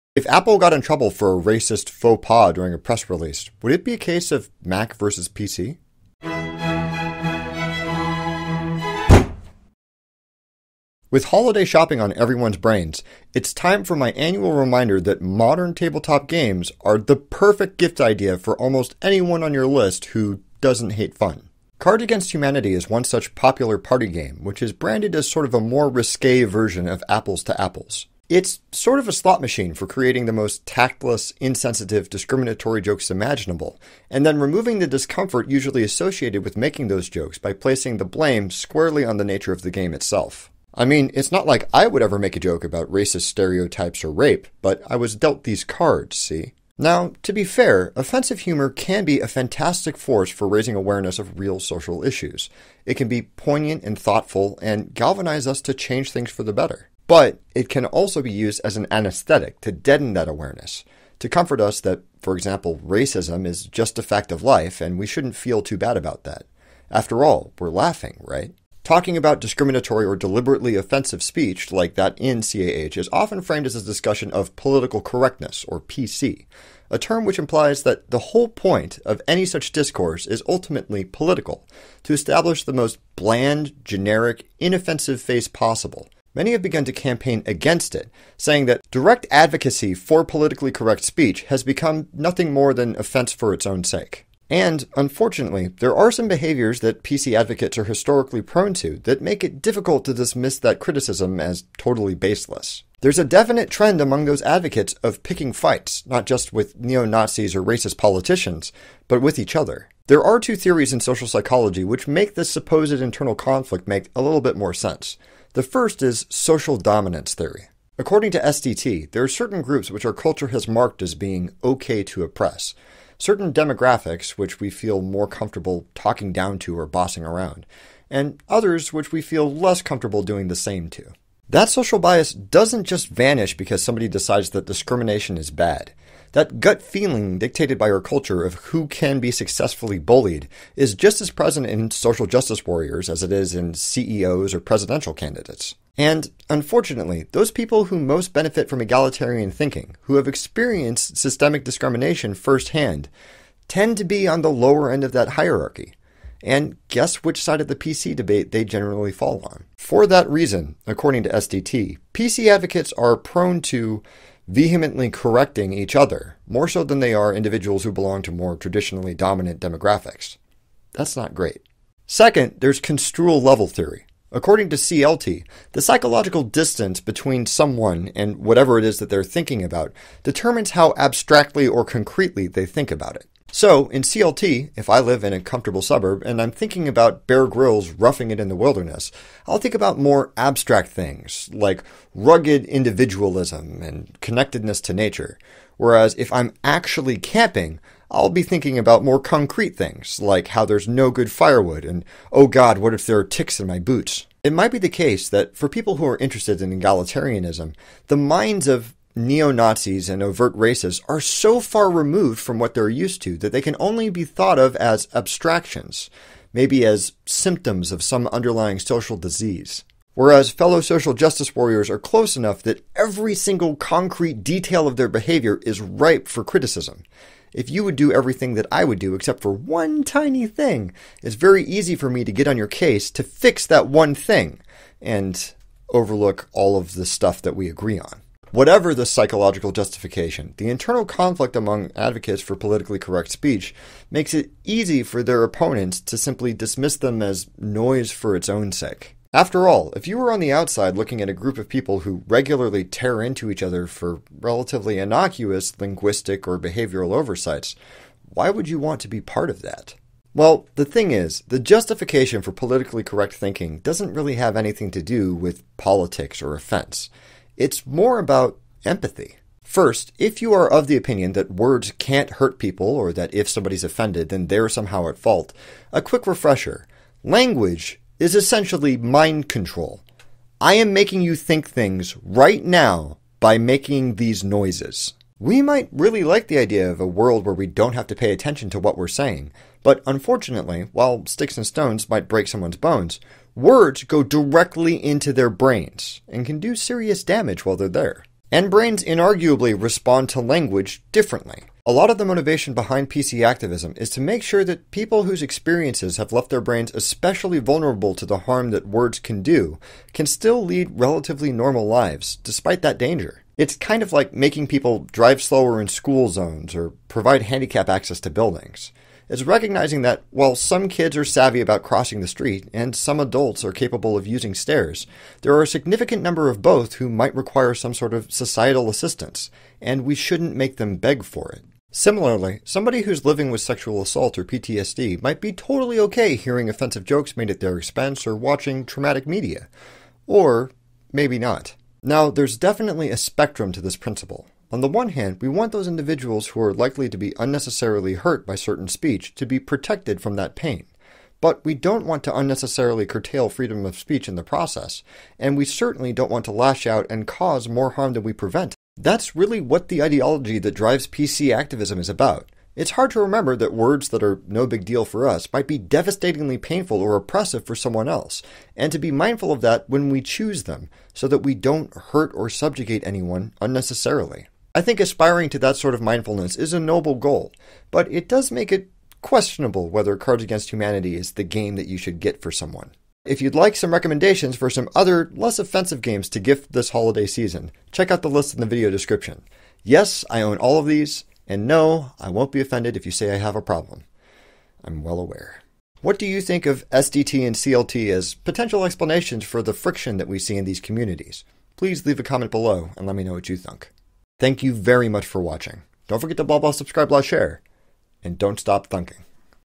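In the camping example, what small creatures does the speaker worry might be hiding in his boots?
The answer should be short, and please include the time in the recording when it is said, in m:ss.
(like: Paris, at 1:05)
Ticks, at 3:23.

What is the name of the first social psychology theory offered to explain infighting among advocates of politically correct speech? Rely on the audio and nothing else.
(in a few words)
Social dominance theory.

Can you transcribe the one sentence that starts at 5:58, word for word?
That's really what the ideology that drives PC activism is about.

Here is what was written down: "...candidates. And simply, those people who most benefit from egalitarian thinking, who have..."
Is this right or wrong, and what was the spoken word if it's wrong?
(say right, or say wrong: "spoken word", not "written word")
wrong: "unfortunately", not "simply".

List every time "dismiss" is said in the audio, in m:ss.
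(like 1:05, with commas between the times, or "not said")
1:40, 4:06.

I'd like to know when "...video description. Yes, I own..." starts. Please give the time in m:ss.
6:28.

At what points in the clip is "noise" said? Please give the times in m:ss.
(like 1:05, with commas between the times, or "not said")
4:07, 4:44.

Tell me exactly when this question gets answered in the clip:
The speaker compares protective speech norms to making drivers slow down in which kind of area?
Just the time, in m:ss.
5:15.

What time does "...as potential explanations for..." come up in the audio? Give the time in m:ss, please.
6:38.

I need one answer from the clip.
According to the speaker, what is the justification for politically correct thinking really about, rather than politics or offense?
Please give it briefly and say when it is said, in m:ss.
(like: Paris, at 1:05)
Empathy, at 4:28.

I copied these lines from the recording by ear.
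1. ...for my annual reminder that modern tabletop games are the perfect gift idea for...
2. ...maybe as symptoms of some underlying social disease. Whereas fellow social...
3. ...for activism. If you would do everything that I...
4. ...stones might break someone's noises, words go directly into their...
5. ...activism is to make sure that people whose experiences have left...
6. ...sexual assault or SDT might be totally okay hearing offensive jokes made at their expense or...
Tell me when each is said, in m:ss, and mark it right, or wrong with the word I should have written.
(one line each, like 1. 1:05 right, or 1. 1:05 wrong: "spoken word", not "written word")
1. 0:13 right
2. 3:36 right
3. 3:46 wrong: "criticism", not "activism"
4. 4:51 wrong: "bones", not "noises"
5. 5:03 right
6. 5:33 wrong: "PTSD", not "SDT".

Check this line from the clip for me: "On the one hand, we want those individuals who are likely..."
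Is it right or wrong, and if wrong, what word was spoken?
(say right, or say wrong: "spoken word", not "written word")
right.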